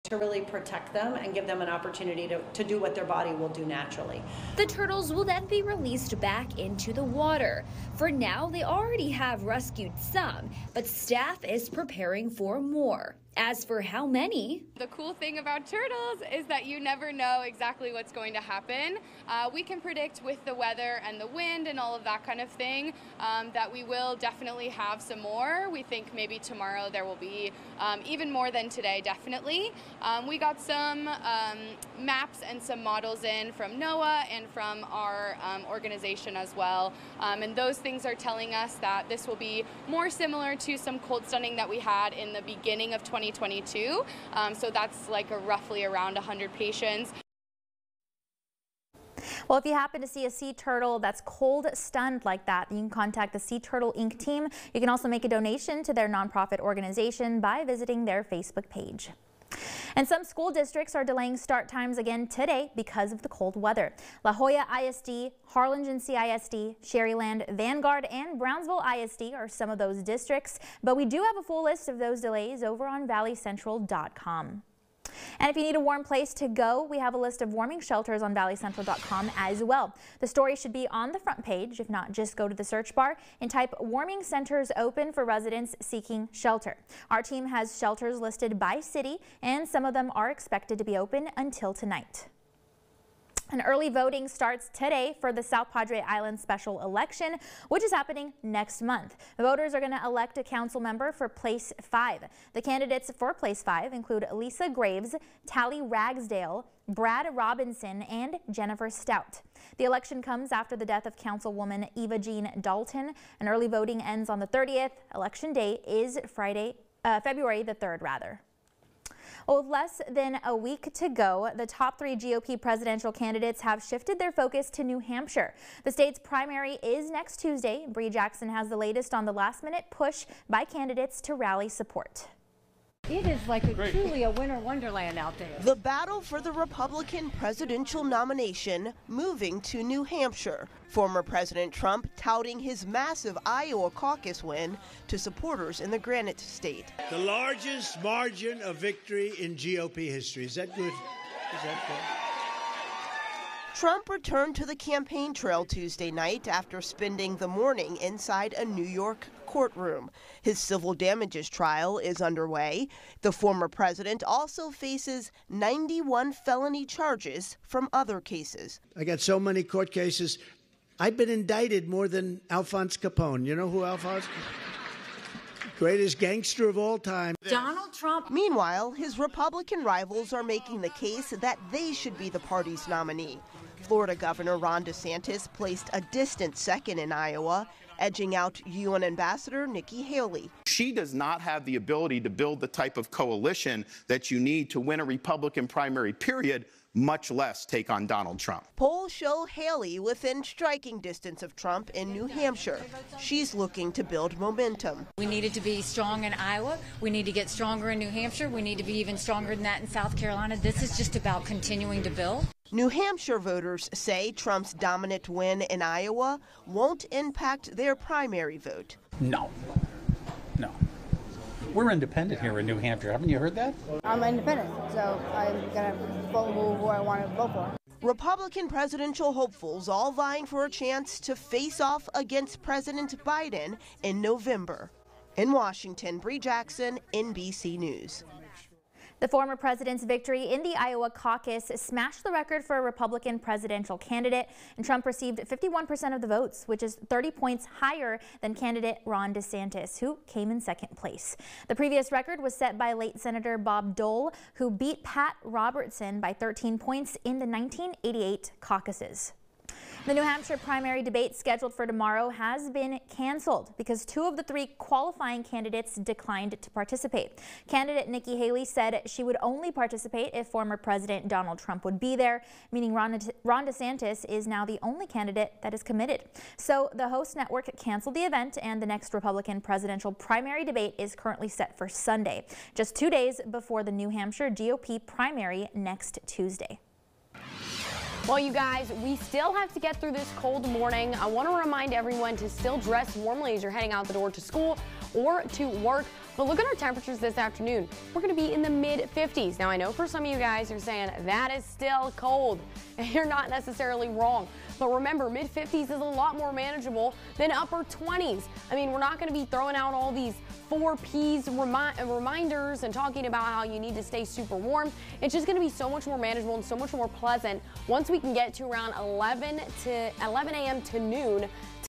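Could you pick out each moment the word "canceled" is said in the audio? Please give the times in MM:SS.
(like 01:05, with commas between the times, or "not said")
04:23, 04:37.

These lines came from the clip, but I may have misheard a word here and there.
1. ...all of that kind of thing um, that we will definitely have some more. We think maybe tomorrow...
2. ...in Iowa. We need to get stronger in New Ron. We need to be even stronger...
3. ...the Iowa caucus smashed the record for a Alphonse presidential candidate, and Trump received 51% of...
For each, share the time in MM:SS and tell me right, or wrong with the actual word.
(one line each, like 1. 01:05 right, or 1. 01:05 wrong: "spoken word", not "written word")
1. 00:21 right
2. 03:26 wrong: "Hampshire", not "Ron"
3. 04:00 wrong: "Republican", not "Alphonse".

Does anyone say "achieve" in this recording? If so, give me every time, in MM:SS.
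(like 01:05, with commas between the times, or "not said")
not said.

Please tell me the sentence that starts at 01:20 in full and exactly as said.
The story should be on the front page.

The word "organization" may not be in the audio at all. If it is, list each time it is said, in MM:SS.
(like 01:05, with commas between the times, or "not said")
00:35, 00:56.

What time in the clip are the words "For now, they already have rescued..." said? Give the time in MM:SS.
00:07.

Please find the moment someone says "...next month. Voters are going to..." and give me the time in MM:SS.
01:38.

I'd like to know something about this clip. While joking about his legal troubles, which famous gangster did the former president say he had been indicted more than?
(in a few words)
Alphonse Capone.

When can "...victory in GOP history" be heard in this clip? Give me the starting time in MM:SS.
02:28.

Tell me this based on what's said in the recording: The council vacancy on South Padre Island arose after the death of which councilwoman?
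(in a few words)
Eva Jean Dalton.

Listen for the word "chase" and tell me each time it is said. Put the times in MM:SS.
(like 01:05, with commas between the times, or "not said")
not said.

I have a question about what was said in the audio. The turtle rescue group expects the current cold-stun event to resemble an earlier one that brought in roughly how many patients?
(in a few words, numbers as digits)
100.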